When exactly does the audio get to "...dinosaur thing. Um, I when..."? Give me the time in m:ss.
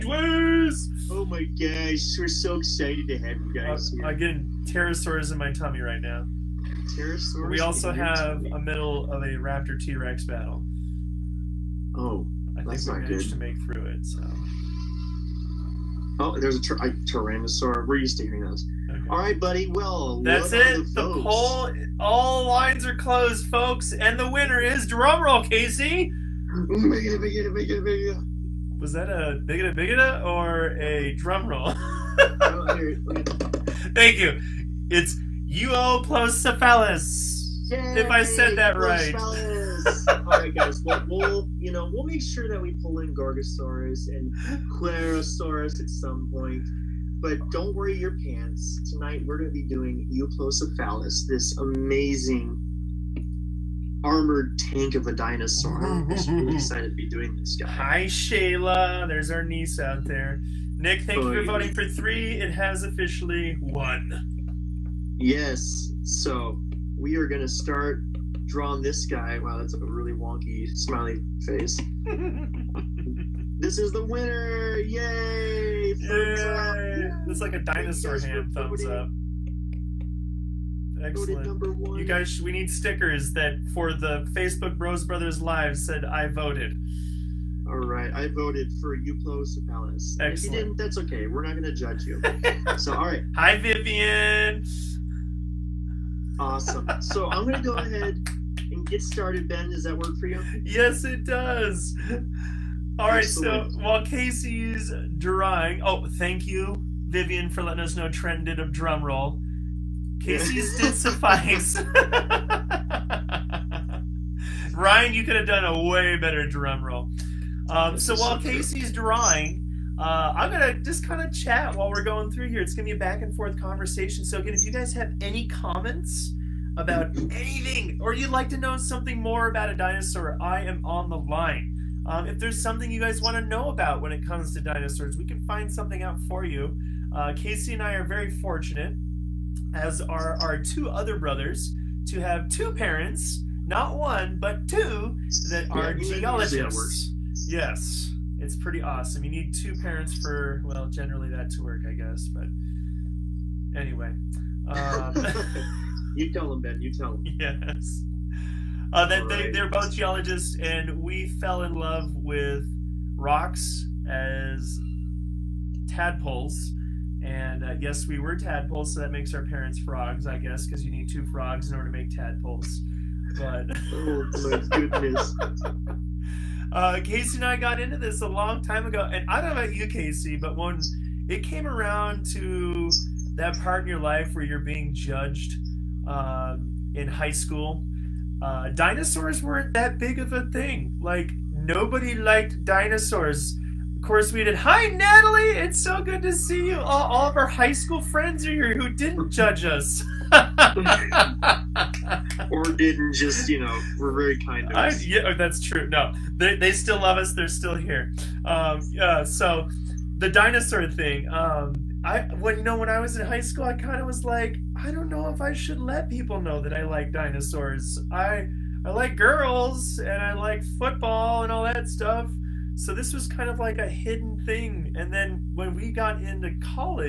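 3:30.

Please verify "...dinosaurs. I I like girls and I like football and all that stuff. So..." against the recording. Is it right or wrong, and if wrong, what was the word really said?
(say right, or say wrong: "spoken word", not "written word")
right.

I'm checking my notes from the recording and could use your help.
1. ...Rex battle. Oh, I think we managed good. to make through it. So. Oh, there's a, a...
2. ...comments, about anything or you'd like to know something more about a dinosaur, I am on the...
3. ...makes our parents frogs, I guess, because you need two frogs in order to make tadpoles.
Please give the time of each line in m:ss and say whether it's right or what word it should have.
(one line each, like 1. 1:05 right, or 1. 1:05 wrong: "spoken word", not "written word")
1. 0:09 right
2. 2:05 right
3. 2:49 right.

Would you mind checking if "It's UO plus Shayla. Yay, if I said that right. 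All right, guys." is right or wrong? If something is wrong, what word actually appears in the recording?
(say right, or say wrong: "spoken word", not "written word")
wrong: "Cephalus", not "Shayla".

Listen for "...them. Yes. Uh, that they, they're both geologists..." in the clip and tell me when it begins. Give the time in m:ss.
2:37.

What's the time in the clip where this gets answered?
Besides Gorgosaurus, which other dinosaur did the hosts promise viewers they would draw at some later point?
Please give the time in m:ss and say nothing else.
0:44.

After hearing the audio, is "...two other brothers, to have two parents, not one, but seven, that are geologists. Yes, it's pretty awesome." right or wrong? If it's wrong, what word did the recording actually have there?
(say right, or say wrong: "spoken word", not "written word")
wrong: "two", not "seven".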